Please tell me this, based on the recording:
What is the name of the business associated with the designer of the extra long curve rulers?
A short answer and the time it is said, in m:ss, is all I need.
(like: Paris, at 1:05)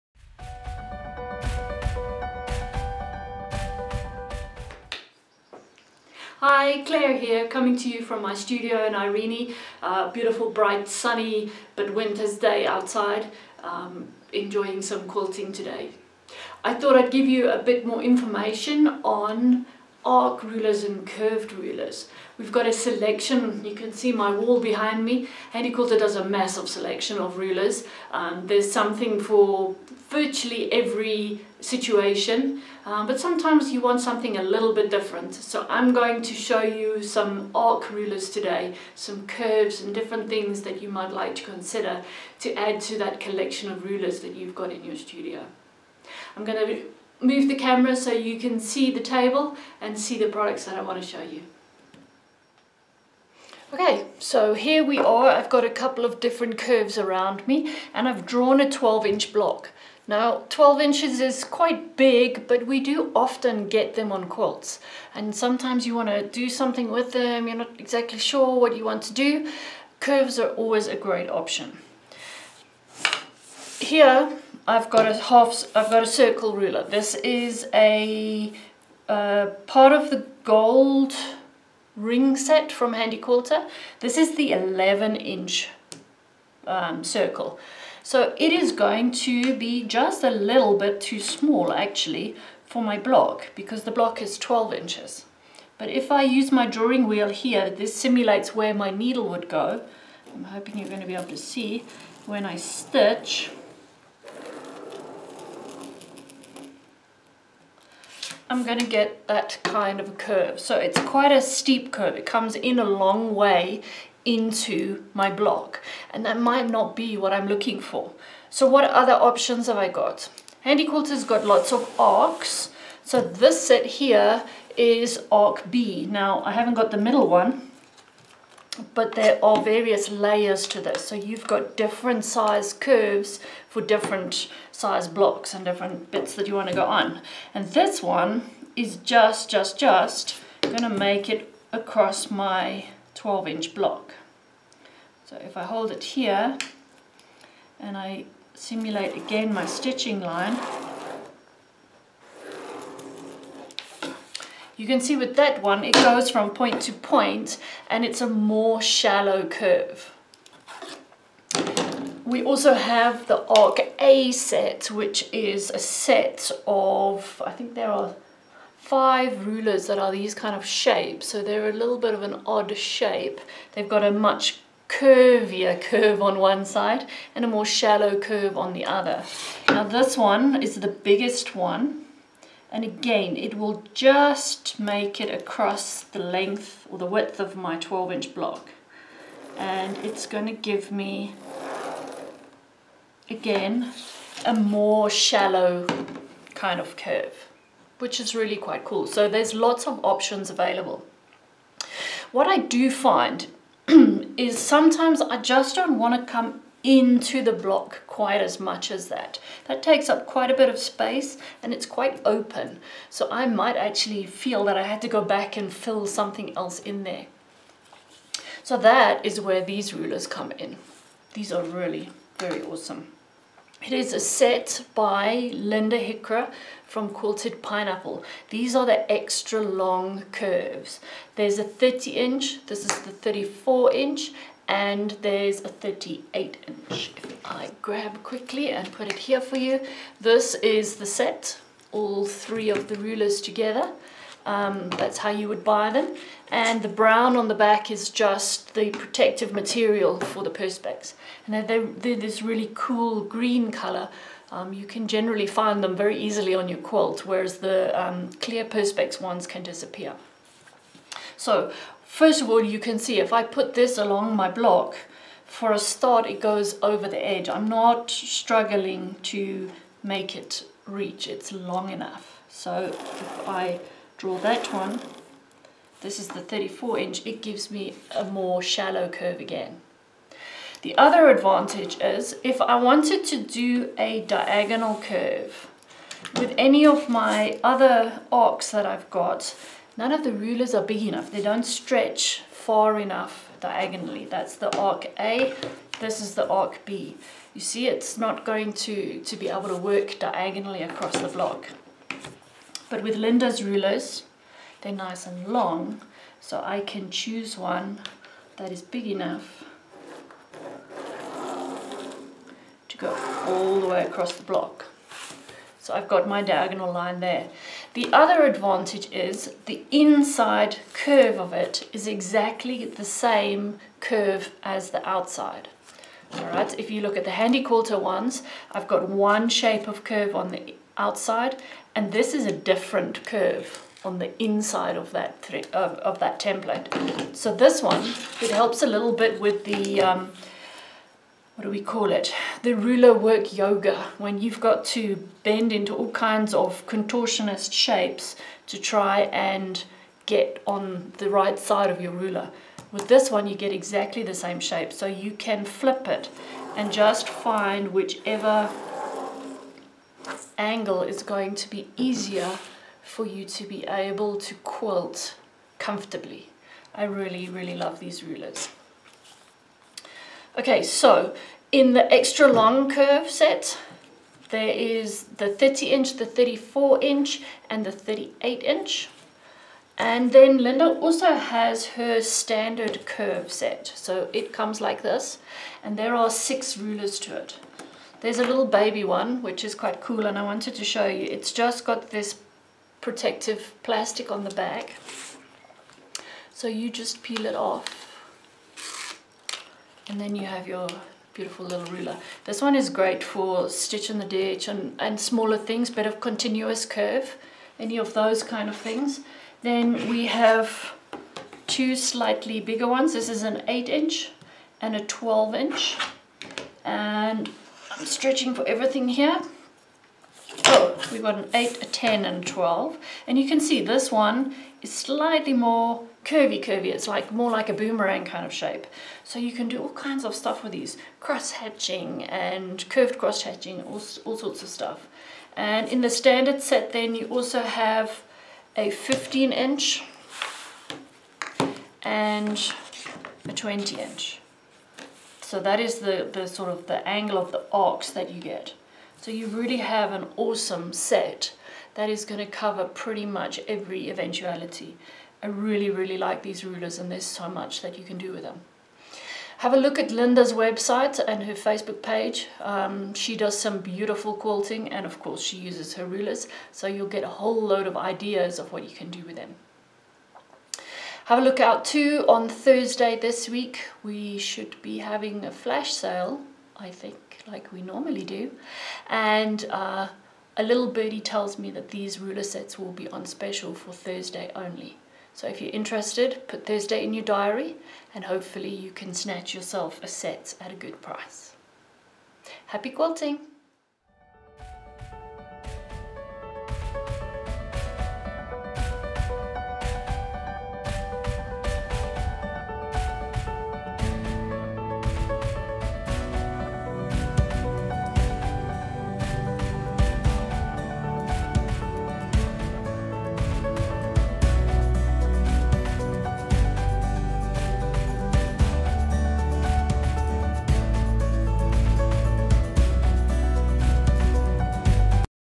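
Quilted Pineapple, at 3:47.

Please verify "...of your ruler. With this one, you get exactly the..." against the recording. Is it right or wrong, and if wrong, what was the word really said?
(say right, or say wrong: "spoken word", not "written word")
right.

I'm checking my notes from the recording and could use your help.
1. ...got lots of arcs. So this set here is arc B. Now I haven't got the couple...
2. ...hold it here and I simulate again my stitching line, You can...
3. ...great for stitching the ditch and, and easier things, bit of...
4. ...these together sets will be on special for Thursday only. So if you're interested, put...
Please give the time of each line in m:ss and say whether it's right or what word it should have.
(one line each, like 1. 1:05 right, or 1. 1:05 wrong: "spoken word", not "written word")
1. 2:01 wrong: "middle", not "couple"
2. 2:25 right
3. 6:42 wrong: "smaller", not "easier"
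4. 8:01 wrong: "ruler", not "together".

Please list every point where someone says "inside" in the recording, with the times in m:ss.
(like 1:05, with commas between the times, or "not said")
5:19, 5:34.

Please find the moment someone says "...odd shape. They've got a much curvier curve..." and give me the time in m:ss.
2:52.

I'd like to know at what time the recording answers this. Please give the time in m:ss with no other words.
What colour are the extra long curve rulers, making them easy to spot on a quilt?
4:13.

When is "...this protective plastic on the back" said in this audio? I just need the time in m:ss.
6:32.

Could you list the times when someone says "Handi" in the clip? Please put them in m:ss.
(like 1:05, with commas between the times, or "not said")
1:22, 2:00, 5:27.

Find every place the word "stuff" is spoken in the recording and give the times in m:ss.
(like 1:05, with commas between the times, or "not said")
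7:10, 7:14.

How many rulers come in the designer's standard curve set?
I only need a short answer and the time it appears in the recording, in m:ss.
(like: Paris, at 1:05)
6, at 6:26.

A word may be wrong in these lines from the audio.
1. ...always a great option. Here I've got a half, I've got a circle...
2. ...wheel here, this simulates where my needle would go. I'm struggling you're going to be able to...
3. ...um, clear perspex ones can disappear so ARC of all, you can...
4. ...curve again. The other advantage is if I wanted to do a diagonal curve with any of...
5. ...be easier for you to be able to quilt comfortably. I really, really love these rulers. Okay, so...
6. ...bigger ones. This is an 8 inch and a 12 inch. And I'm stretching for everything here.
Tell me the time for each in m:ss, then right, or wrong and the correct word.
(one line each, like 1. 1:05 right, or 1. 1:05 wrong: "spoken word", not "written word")
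1. 1:10 right
2. 1:37 wrong: "hoping", not "struggling"
3. 4:18 wrong: "First", not "ARC"
4. 4:39 right
5. 6:01 right
6. 6:52 right.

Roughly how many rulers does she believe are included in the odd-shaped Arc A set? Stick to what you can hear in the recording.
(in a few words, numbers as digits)
5.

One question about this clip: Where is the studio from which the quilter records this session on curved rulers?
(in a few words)
Irene.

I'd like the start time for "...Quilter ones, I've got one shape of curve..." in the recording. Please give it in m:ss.
5:27.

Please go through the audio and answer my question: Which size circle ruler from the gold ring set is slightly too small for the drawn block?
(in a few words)
11 inch.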